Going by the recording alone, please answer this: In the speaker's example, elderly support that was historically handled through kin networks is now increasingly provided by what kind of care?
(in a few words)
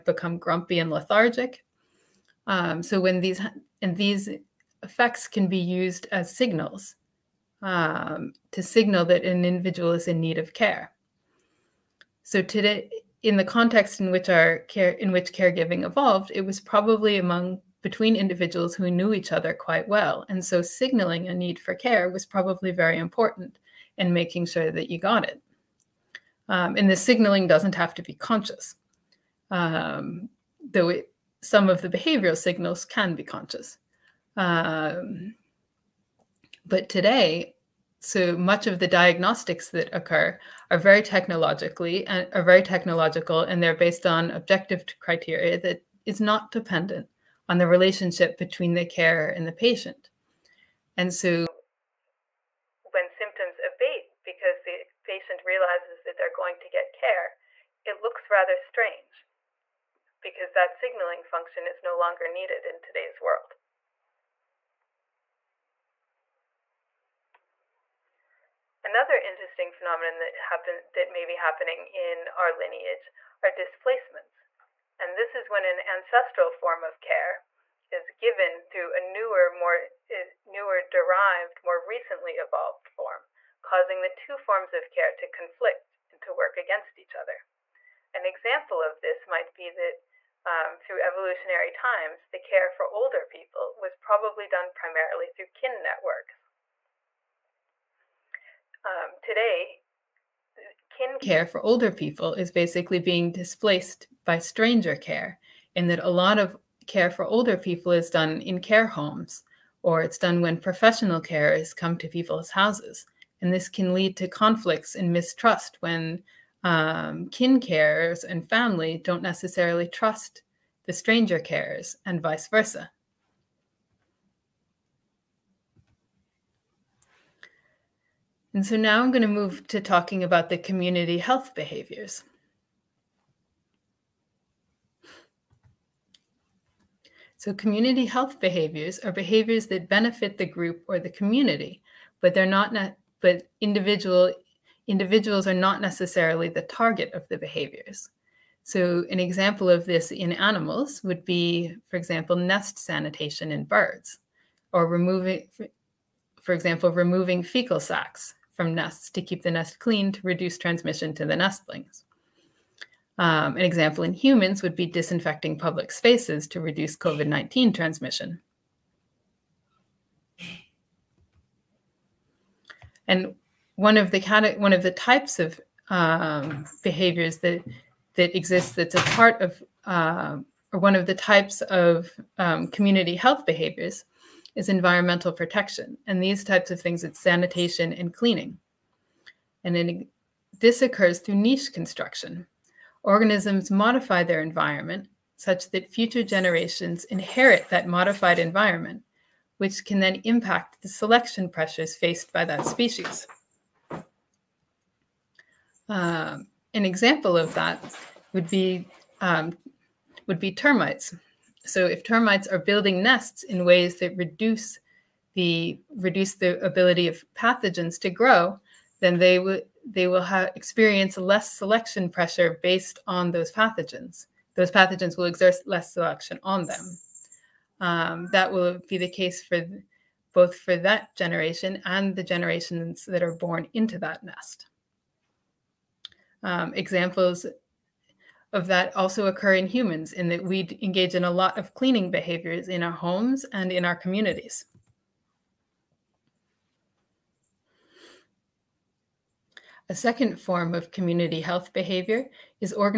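Stranger care.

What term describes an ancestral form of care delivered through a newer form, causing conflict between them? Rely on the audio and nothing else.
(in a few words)
Displacements.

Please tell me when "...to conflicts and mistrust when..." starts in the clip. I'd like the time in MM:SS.
01:54.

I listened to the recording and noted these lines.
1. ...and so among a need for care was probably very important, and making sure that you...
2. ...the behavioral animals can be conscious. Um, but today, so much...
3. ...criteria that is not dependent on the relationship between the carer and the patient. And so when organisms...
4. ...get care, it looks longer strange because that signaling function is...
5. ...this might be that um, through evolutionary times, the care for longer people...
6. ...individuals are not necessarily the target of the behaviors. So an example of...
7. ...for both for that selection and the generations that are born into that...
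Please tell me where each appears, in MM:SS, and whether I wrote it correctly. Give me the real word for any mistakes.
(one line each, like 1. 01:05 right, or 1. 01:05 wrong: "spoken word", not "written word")
1. 00:20 wrong: "signaling", not "among"
2. 00:31 wrong: "signals", not "animals"
3. 00:44 wrong: "symptoms", not "organisms"
4. 00:56 wrong: "rather", not "longer"
5. 01:28 wrong: "older", not "longer"
6. 02:24 right
7. 03:49 wrong: "generation", not "selection".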